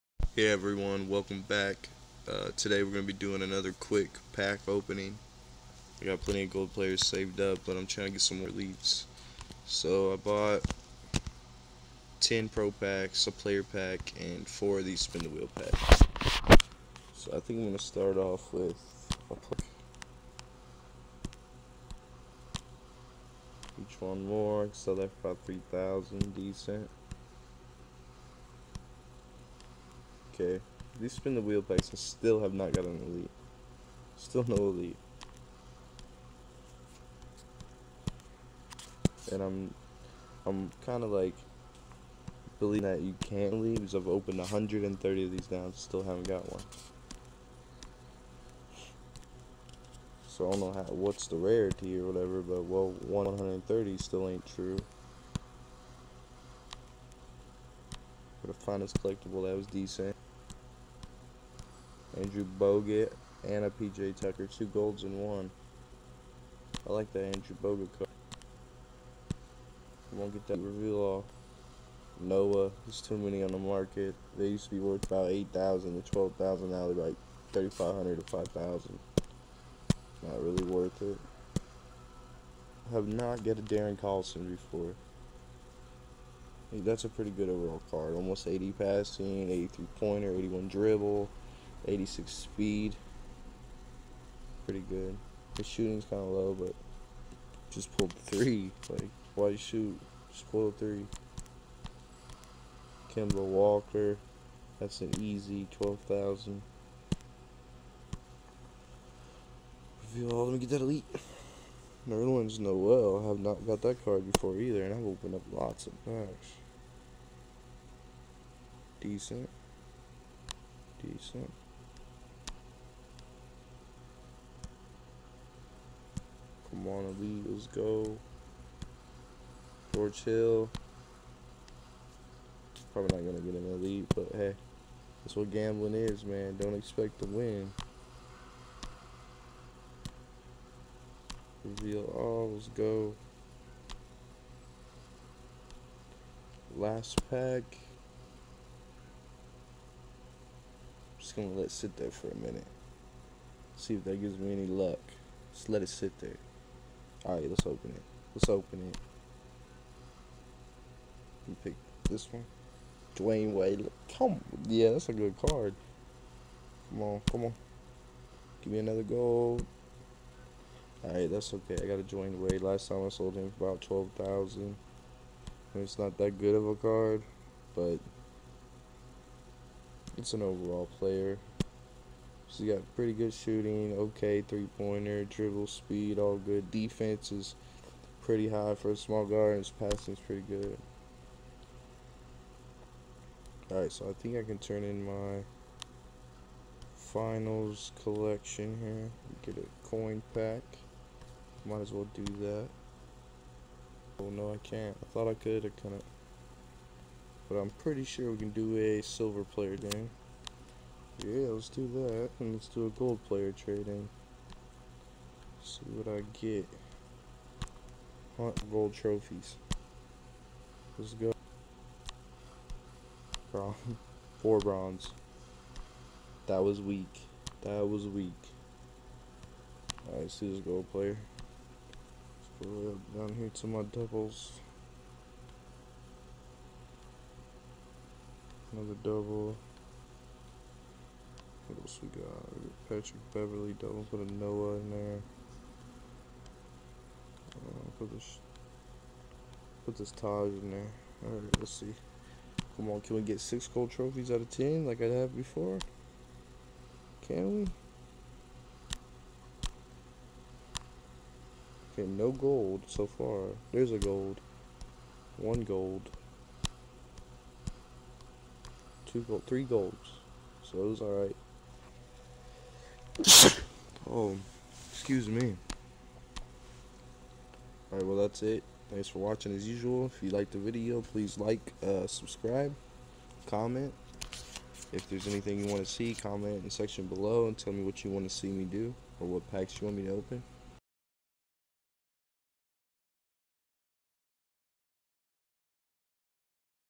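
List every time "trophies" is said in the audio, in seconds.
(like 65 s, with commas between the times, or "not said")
218 s, 253 s.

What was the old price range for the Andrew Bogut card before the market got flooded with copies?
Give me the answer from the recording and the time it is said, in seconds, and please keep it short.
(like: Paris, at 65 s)
8000 to 12000, at 75 s.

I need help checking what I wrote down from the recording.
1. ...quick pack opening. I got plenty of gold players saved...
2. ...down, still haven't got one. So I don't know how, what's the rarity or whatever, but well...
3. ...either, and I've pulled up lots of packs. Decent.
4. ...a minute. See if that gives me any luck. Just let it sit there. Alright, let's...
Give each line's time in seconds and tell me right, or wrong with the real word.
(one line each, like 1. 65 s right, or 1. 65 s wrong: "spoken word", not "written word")
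1. 3 s right
2. 45 s right
3. 114 s wrong: "opened", not "pulled"
4. 152 s right.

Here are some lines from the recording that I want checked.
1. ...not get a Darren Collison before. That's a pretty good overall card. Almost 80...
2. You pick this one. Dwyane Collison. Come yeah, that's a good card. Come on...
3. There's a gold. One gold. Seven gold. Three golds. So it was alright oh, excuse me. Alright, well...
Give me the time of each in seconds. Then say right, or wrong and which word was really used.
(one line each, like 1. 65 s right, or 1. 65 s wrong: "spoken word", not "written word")
1. 83 s right
2. 161 s wrong: "Wade", not "Collison"
3. 263 s wrong: "Two", not "Seven".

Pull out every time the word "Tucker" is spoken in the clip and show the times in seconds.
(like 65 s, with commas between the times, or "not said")
64 s.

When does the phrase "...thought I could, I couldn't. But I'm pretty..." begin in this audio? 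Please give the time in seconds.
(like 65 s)
205 s.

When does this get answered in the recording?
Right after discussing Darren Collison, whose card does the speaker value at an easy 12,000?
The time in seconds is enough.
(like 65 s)
103 s.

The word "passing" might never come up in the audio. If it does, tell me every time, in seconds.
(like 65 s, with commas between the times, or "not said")
88 s, 189 s.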